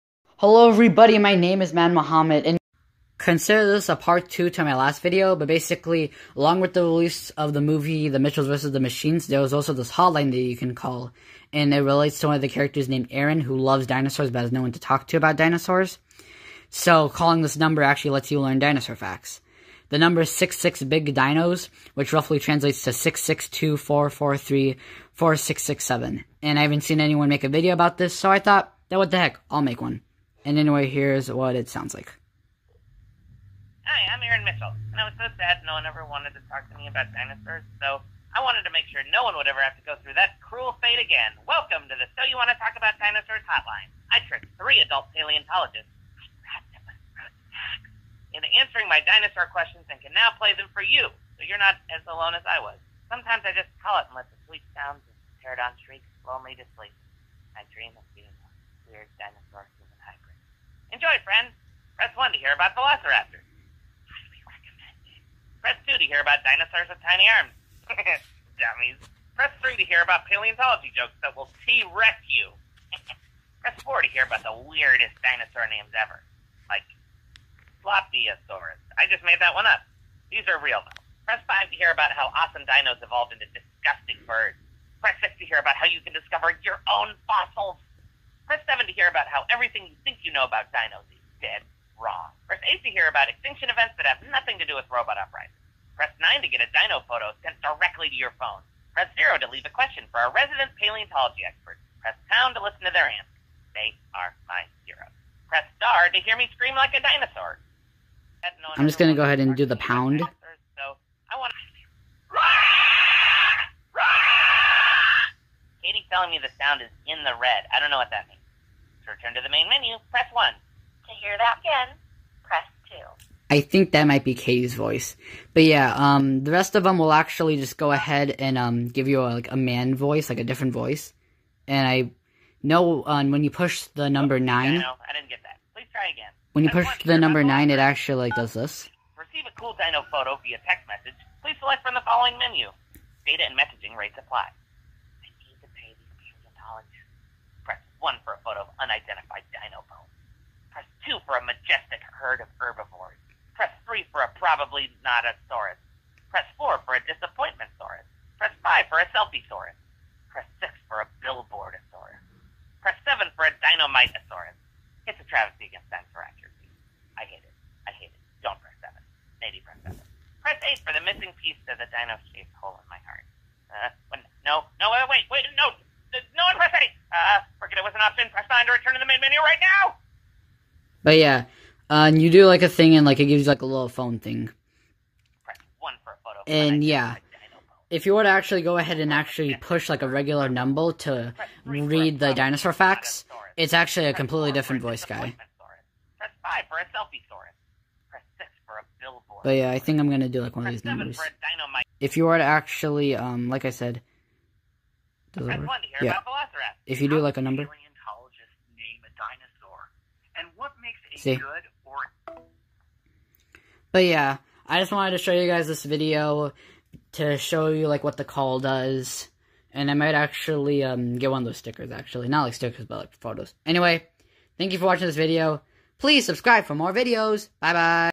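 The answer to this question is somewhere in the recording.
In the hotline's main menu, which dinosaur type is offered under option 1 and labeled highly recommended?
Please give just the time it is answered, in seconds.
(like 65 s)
62 s.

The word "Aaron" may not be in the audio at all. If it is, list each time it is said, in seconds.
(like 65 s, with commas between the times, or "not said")
13 s, 34 s.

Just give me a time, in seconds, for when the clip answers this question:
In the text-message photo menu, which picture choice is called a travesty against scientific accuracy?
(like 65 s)
163 s.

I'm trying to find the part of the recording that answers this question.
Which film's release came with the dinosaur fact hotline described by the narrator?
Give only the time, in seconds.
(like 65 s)
8 s.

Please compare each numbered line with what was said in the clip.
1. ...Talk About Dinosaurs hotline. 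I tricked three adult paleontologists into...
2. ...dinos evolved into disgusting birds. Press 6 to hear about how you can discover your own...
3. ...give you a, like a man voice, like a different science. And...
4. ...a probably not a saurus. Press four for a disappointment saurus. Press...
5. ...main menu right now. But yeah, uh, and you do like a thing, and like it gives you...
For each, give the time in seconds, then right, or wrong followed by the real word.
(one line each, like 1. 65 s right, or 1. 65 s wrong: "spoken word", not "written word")
1. 42 s right
2. 82 s right
3. 128 s wrong: "voice", not "science"
4. 154 s right
5. 179 s right.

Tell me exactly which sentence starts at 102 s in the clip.
Press pound to listen to their answer.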